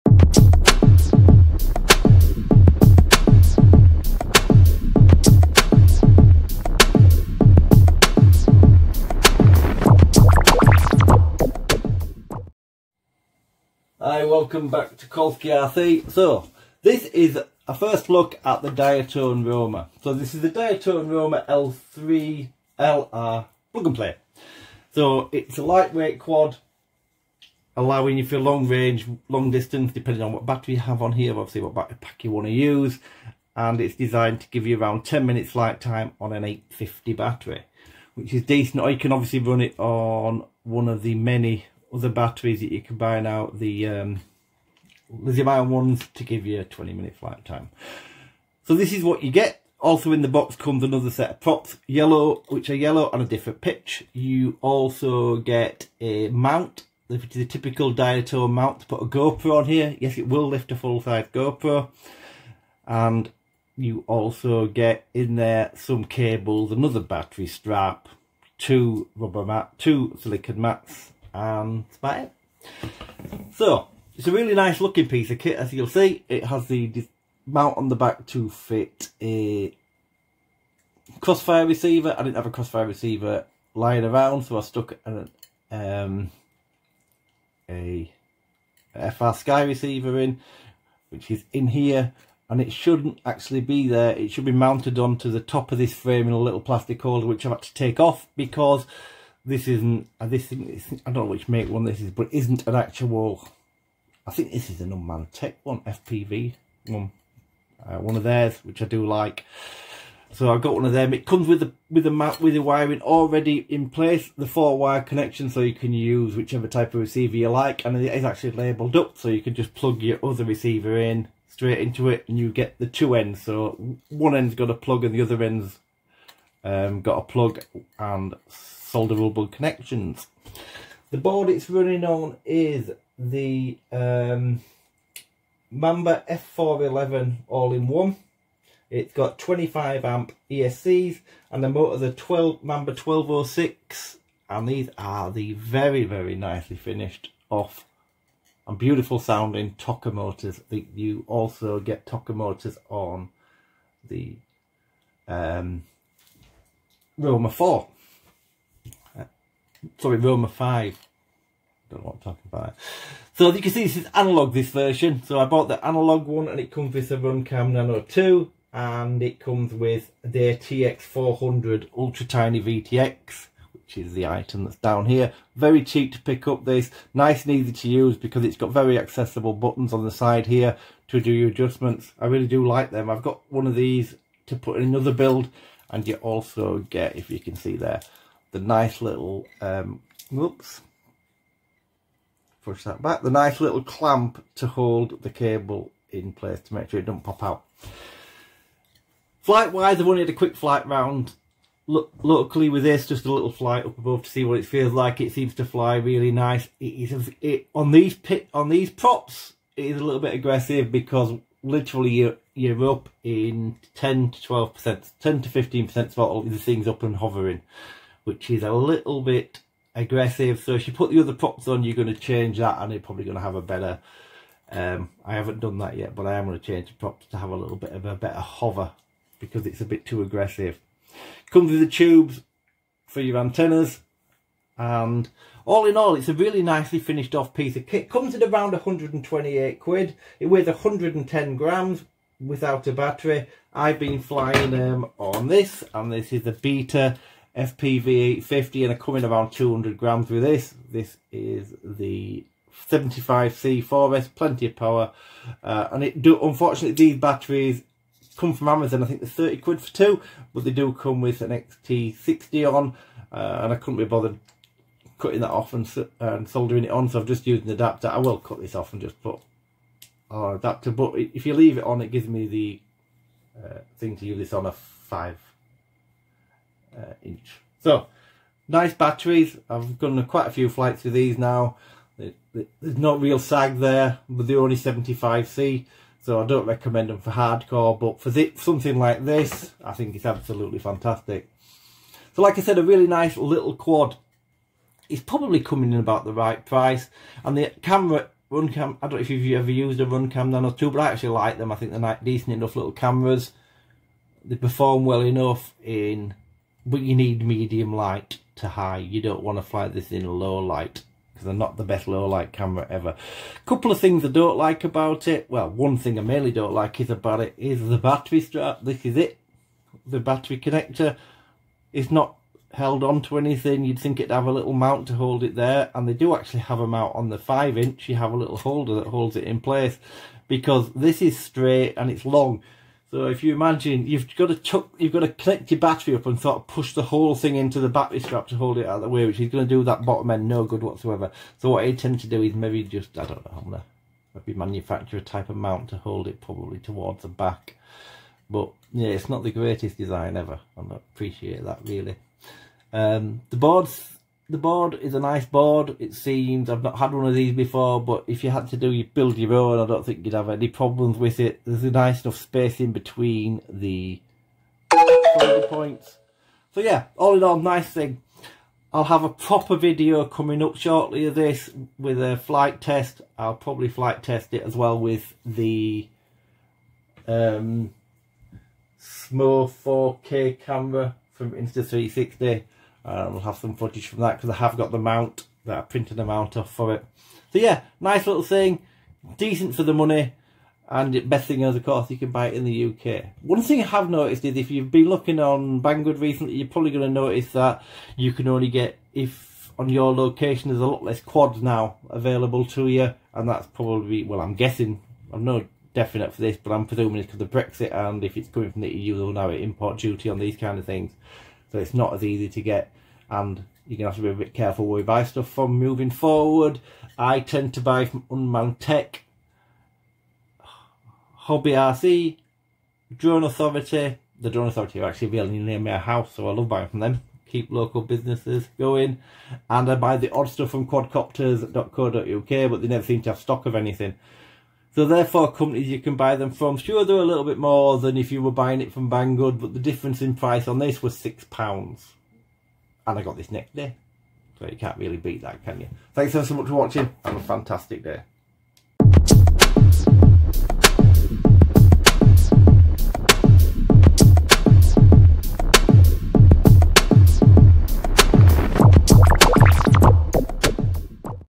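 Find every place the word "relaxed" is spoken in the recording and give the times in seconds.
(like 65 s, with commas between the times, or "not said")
not said.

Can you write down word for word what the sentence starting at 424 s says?
The Drone Authority are actually really near my house, so I love buying from them.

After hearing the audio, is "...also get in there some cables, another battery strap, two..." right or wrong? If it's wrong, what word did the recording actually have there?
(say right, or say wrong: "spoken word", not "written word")
right.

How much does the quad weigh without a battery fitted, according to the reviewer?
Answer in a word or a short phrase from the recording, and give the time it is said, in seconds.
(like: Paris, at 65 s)
110 grams, at 240 s.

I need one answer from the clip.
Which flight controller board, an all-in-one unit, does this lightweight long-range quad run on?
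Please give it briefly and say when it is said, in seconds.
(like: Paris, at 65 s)
Mamba F411, at 135 s.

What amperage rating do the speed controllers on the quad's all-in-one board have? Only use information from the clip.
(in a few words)
25 amp.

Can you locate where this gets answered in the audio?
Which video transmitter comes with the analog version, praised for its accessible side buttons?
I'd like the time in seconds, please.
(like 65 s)
170 s.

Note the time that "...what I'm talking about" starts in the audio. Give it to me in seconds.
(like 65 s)
162 s.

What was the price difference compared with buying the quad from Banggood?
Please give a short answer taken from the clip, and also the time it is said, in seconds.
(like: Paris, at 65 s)
£6, at 441 s.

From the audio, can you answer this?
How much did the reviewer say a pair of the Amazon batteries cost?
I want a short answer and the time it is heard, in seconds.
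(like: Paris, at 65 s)
30 quid, at 259 s.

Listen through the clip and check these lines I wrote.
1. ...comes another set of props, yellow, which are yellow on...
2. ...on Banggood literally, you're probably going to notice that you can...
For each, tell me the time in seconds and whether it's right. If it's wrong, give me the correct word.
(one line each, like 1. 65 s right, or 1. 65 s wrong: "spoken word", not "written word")
1. 50 s right
2. 395 s wrong: "recently", not "literally".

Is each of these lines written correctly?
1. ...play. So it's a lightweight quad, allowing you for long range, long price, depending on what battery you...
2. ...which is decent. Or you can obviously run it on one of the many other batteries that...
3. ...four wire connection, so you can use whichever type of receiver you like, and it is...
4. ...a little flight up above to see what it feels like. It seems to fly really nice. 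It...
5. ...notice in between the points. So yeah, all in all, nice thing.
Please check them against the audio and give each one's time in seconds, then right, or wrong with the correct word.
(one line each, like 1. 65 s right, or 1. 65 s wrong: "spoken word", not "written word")
1. 23 s wrong: "distance", not "price"
2. 38 s right
3. 114 s right
4. 203 s right
5. 362 s wrong: "space", not "notice".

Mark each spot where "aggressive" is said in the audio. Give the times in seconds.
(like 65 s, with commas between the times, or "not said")
210 s, 219 s, 230 s.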